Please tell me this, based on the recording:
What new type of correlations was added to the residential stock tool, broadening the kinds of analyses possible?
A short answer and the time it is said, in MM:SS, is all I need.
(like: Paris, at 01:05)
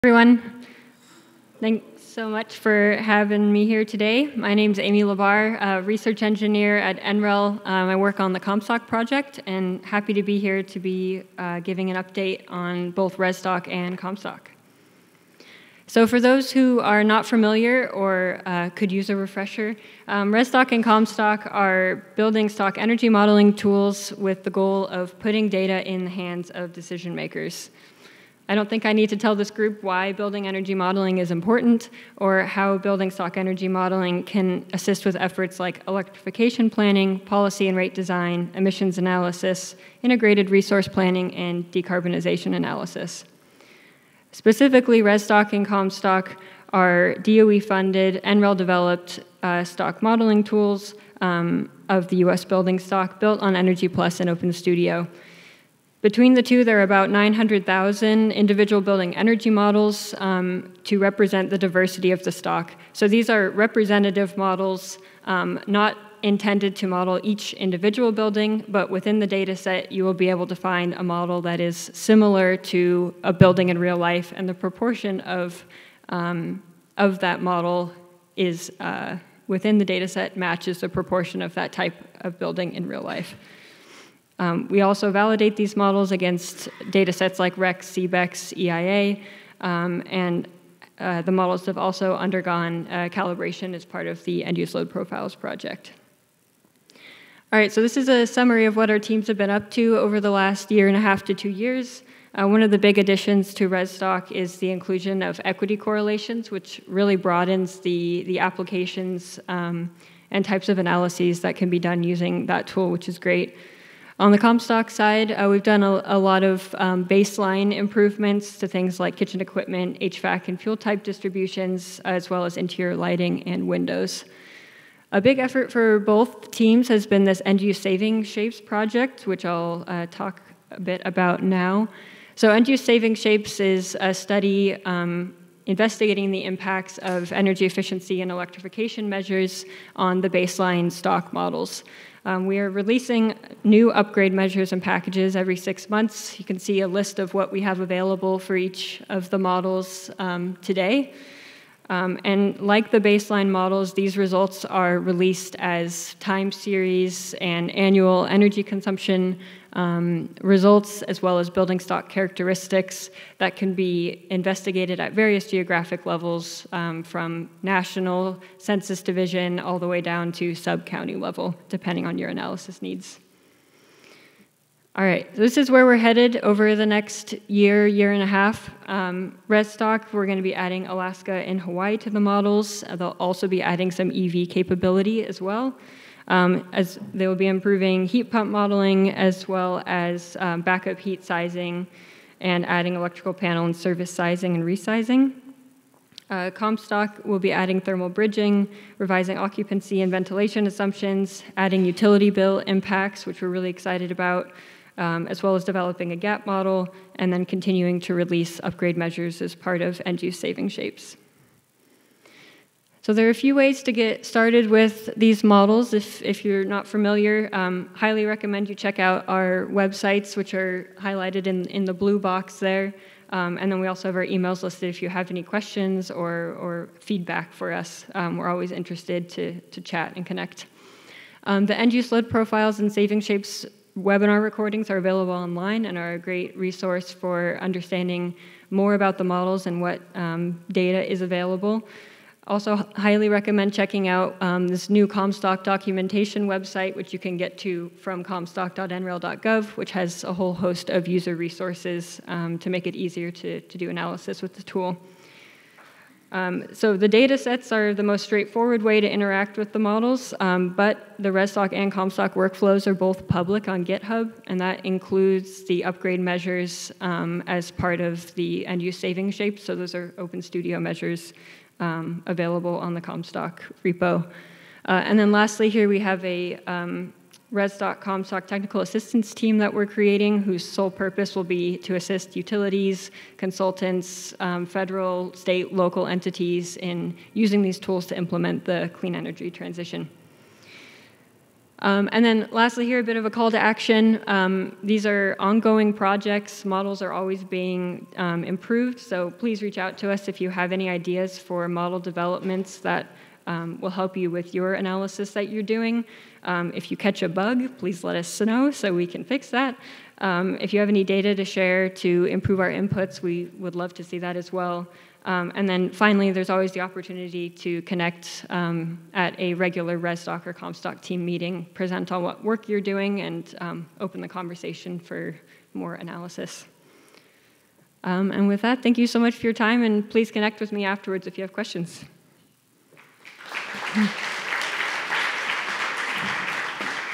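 equity correlations, at 01:45.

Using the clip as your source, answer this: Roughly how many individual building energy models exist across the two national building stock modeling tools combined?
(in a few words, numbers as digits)
900,000.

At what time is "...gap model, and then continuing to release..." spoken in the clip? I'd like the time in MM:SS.
03:26.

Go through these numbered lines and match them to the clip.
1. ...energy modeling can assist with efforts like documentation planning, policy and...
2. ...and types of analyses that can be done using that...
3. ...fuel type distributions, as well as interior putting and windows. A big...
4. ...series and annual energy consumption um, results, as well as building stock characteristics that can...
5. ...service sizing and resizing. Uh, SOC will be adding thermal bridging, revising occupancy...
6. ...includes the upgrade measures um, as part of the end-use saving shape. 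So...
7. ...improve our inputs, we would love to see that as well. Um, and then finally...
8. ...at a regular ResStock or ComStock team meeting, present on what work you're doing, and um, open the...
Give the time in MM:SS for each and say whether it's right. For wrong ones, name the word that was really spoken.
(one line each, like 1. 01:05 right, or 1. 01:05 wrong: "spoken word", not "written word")
1. 00:33 wrong: "electrification", not "documentation"
2. 01:50 right
3. 02:00 wrong: "lighting", not "putting"
4. 02:36 right
5. 03:13 wrong: "ComStock", not "SOC"
6. 04:24 right
7. 05:12 right
8. 05:19 right.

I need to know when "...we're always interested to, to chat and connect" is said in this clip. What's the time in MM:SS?
03:48.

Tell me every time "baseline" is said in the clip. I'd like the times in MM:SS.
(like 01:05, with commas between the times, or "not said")
01:57, 02:20, 02:32.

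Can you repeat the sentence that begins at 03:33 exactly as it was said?
So there are a few ways to get started with these models.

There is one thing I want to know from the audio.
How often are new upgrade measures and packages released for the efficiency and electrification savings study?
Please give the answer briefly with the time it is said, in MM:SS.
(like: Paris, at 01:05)
every six months, at 02:25.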